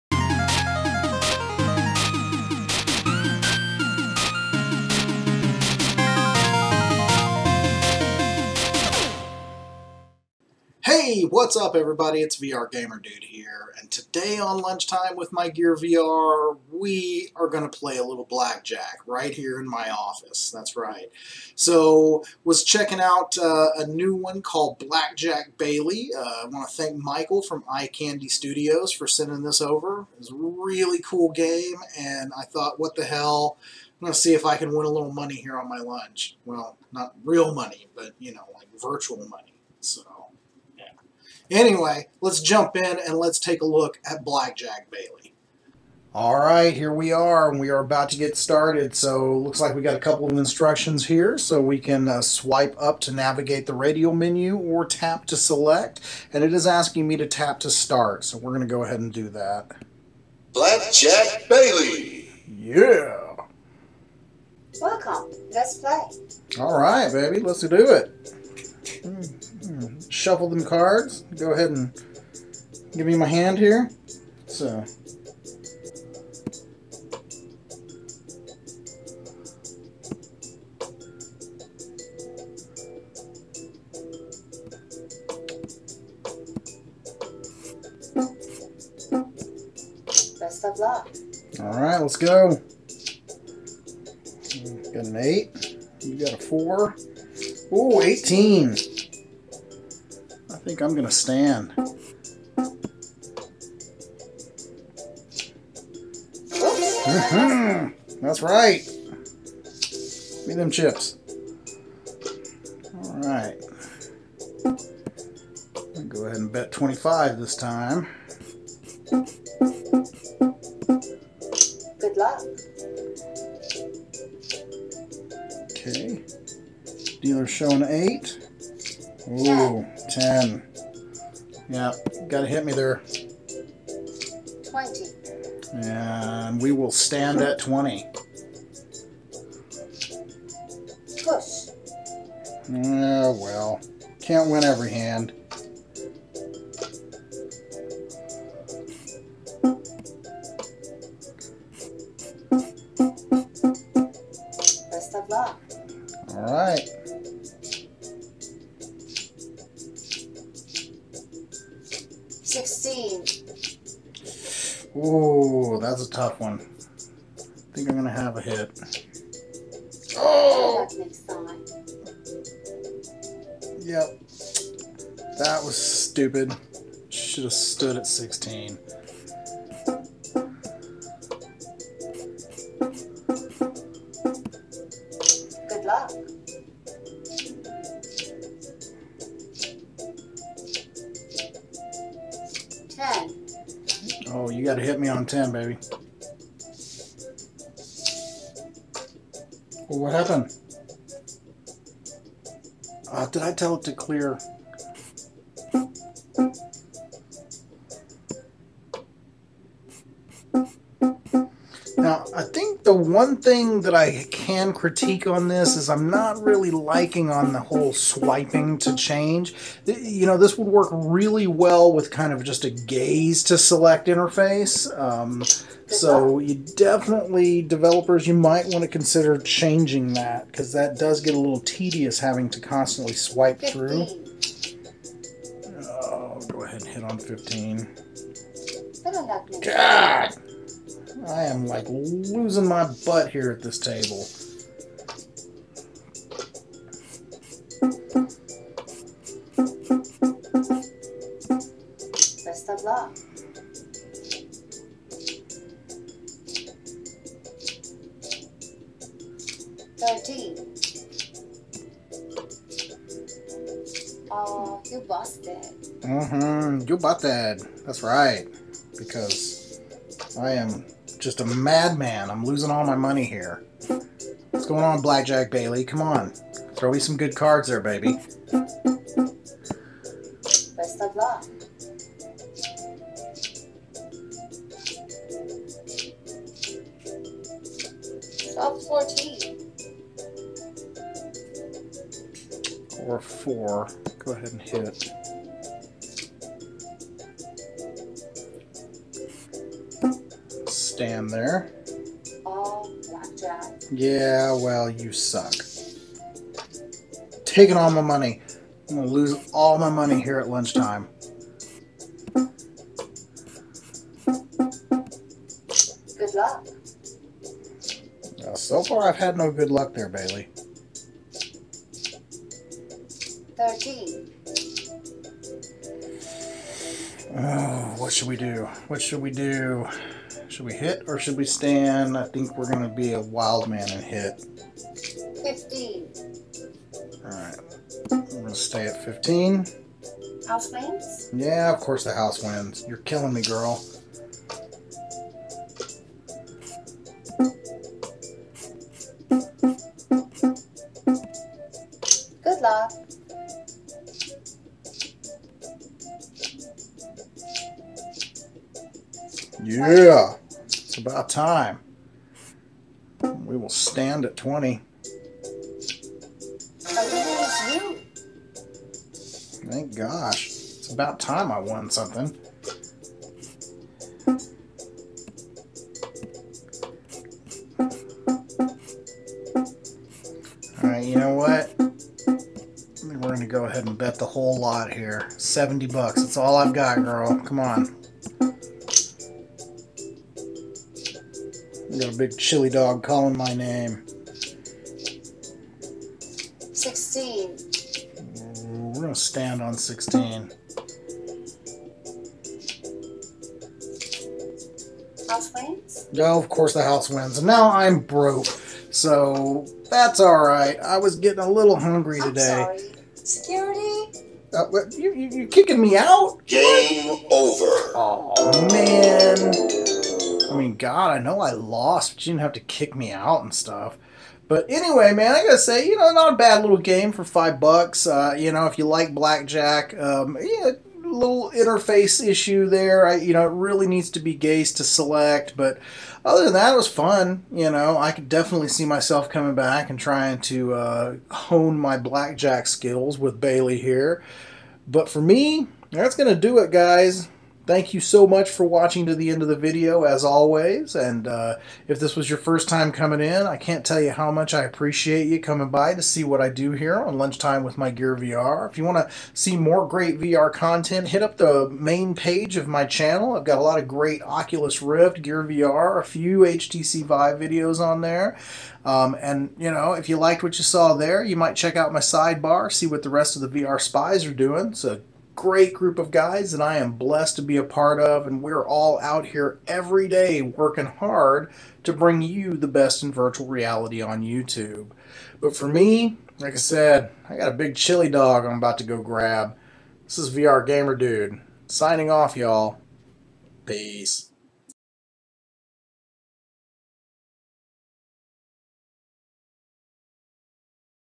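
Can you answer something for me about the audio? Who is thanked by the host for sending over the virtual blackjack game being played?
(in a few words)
Michael.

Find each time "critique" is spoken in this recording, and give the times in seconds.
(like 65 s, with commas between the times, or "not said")
214 s.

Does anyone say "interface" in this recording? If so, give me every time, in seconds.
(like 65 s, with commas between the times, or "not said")
224 s, 431 s.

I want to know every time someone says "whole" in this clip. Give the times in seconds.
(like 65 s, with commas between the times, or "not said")
217 s, 384 s.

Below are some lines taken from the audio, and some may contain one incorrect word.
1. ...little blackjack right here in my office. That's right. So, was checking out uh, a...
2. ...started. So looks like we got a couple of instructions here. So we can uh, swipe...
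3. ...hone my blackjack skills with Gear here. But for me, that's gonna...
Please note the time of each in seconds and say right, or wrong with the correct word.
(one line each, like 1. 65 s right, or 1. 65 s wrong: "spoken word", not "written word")
1. 18 s right
2. 48 s right
3. 441 s wrong: "Bailey", not "Gear".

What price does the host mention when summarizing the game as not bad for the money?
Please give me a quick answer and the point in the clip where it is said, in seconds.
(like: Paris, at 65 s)
5 dollars, at 427 s.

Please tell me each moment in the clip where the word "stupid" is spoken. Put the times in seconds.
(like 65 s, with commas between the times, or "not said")
175 s.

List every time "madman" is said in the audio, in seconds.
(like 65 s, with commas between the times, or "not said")
271 s.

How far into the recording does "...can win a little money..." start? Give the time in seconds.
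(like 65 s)
34 s.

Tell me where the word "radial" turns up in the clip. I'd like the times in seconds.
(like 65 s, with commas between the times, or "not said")
53 s.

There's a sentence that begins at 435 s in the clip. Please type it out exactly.
But other than that, it was fun.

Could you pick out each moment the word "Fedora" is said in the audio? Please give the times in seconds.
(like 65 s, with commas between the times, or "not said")
not said.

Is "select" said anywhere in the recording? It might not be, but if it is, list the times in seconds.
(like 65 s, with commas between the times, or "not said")
55 s, 223 s, 434 s.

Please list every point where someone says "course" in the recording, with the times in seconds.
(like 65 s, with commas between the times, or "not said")
341 s, 406 s.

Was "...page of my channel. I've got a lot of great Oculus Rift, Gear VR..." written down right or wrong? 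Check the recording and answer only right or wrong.
right.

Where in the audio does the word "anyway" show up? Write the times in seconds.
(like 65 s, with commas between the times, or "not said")
41 s, 424 s.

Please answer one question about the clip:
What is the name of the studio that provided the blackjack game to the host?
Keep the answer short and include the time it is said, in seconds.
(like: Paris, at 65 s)
Eye Candy Studios, at 27 s.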